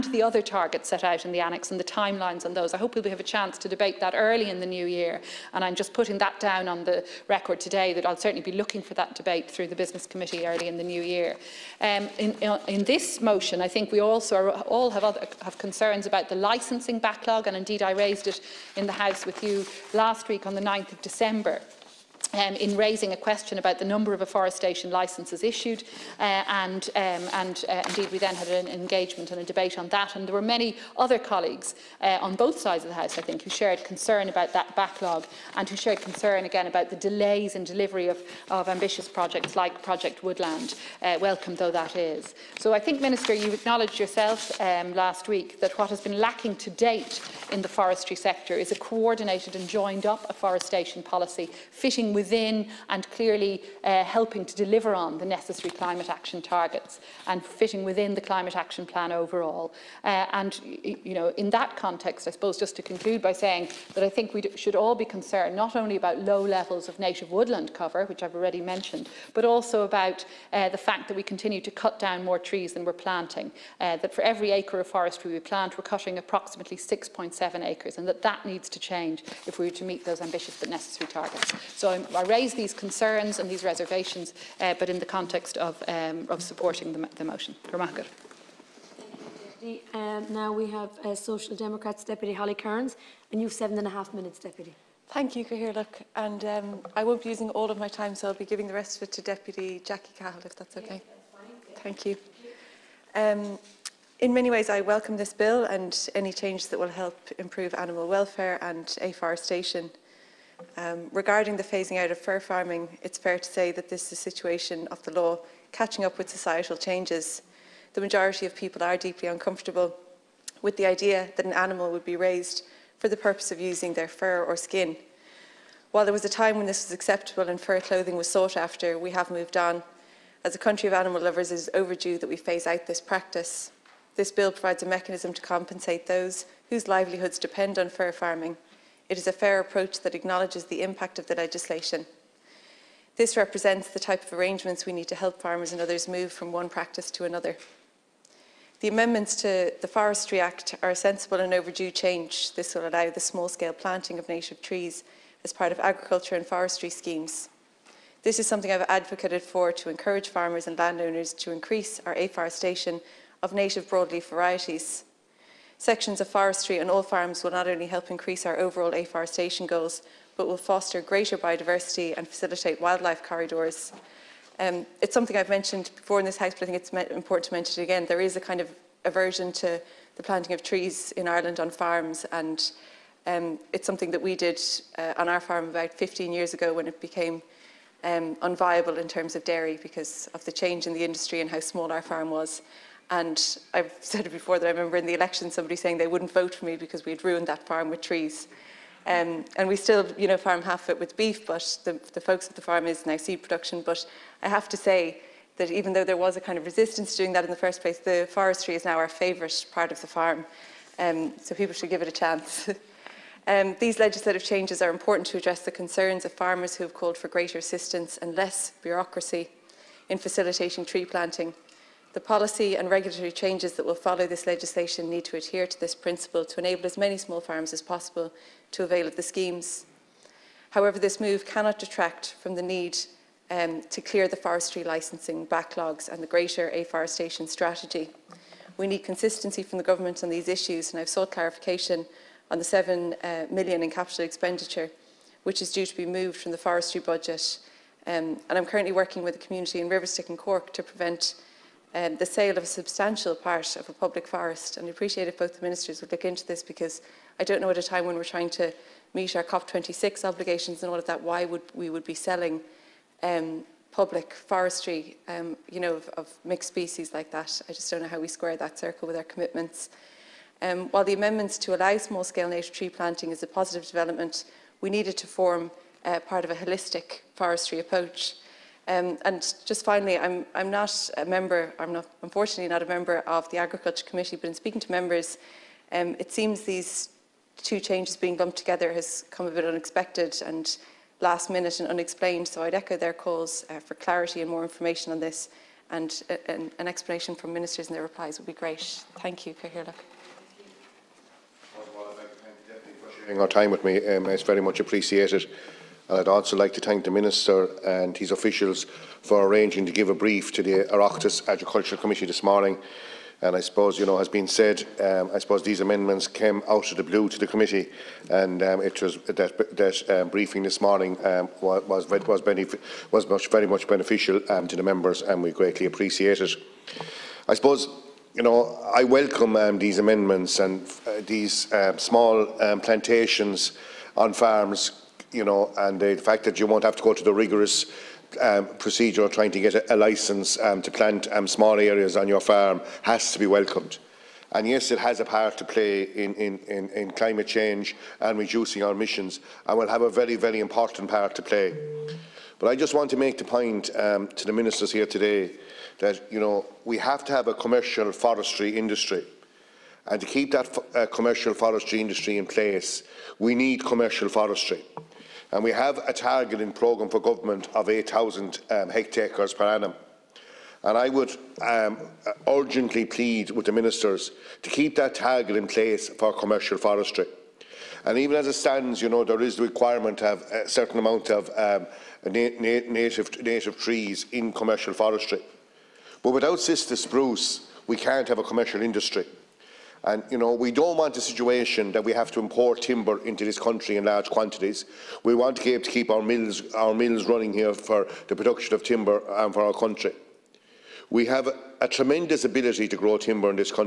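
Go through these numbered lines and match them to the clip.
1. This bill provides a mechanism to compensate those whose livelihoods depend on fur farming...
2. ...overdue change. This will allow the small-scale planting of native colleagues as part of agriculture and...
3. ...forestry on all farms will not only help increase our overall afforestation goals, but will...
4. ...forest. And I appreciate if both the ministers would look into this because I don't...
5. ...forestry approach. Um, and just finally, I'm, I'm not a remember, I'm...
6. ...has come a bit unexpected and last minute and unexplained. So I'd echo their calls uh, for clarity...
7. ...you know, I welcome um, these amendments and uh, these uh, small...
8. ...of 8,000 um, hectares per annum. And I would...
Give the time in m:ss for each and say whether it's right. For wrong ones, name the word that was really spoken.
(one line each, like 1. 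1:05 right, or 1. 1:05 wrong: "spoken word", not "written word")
1. 2:14 right
2. 2:31 wrong: "trees", not "colleagues"
3. 2:46 right
4. 4:14 right
5. 4:37 wrong: "member", not "remember"
6. 4:48 right
7. 5:28 right
8. 6:07 right.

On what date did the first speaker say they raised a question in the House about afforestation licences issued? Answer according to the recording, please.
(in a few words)
9th of December.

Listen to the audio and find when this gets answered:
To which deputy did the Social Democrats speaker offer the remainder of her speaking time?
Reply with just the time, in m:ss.
1:39.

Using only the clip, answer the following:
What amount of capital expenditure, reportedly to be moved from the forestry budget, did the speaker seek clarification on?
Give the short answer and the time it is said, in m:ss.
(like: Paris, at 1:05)
7 million, at 4:02.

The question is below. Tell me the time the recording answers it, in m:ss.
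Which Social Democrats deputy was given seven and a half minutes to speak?
1:32.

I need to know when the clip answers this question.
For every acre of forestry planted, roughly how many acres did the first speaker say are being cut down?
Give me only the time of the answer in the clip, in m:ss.
1:16.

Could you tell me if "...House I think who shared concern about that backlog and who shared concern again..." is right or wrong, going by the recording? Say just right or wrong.
right.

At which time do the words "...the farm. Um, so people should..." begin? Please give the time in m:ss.
3:29.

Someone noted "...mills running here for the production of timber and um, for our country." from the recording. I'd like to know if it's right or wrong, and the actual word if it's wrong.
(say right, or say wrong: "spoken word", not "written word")
right.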